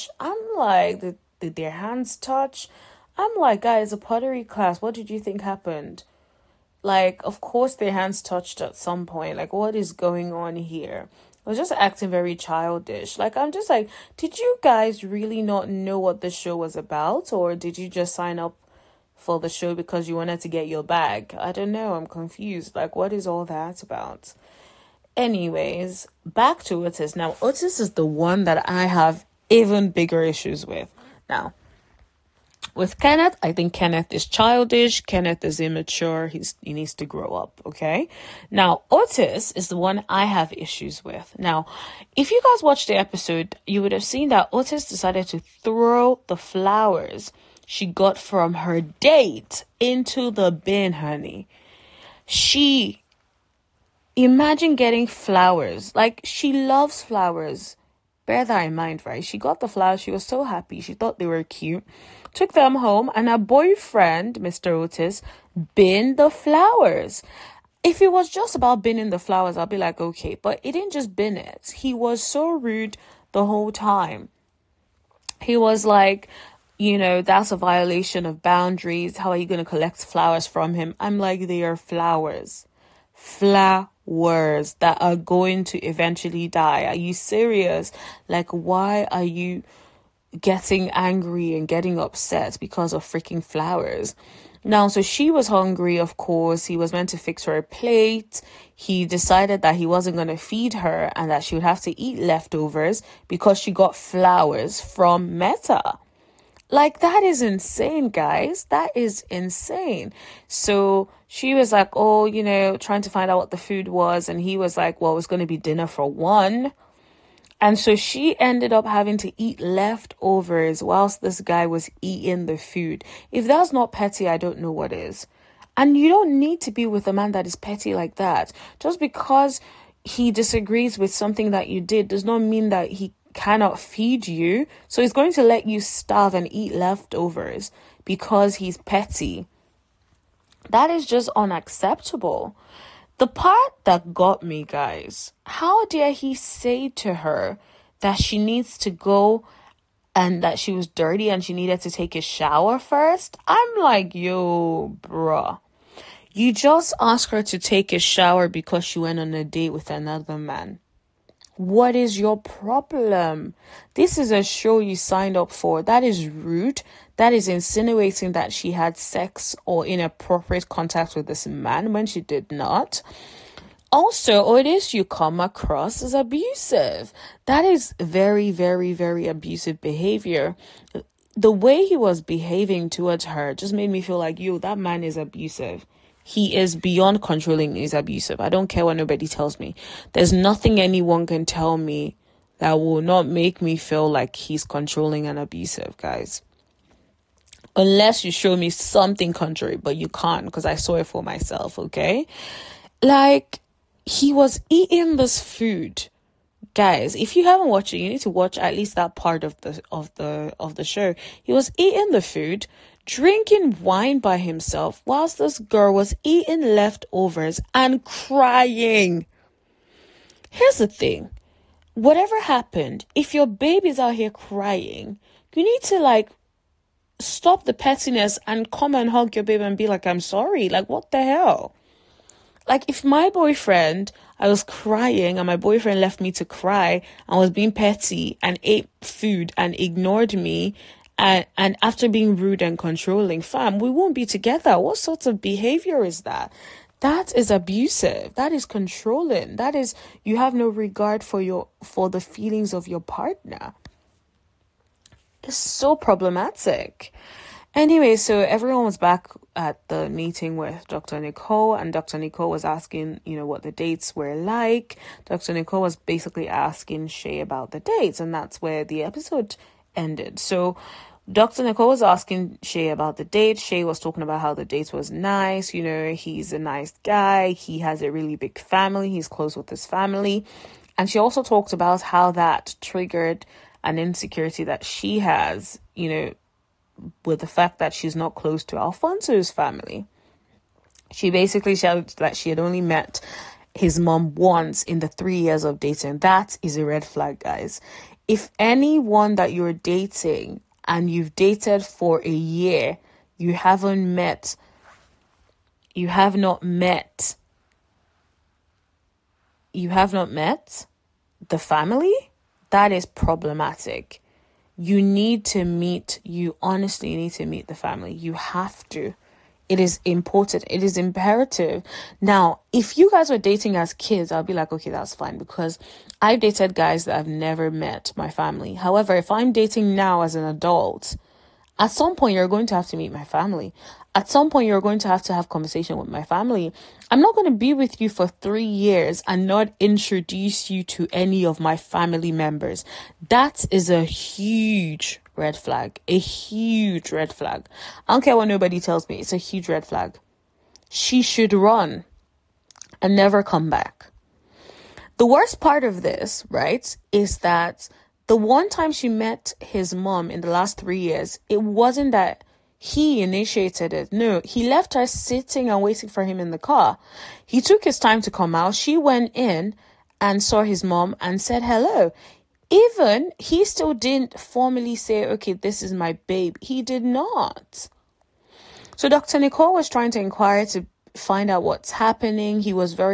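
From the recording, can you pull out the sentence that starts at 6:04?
No, he left her sitting and waiting for him in the car.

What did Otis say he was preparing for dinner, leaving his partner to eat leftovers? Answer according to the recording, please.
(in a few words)
Dinner for one.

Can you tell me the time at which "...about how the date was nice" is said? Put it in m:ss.
4:34.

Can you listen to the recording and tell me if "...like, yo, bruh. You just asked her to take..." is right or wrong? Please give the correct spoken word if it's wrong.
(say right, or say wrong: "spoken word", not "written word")
right.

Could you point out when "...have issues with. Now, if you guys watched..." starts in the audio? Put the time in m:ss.
0:40.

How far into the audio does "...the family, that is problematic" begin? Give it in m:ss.
5:11.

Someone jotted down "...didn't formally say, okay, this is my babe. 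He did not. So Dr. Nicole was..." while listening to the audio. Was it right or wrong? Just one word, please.
right.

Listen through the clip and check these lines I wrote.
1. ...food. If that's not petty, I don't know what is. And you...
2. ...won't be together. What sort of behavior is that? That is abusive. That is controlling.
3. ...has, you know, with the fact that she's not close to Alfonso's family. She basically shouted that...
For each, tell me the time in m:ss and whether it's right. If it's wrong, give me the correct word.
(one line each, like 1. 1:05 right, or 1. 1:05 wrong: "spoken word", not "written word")
1. 2:02 right
2. 4:03 right
3. 4:45 right.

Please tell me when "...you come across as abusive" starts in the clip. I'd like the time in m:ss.
2:54.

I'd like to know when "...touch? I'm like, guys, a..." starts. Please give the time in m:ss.
0:02.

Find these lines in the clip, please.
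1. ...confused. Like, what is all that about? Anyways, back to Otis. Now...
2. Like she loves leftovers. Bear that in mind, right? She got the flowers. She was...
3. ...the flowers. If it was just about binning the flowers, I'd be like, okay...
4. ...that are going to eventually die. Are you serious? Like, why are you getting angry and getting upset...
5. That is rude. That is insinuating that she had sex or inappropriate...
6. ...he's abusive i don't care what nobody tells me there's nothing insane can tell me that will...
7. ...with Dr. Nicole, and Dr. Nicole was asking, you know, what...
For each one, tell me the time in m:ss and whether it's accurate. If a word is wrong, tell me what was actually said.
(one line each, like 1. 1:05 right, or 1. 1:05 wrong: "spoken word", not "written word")
1. 0:22 right
2. 0:55 wrong: "flowers", not "leftovers"
3. 1:06 right
4. 1:24 right
5. 2:45 right
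6. 3:07 wrong: "anyone", not "insane"
7. 4:20 right.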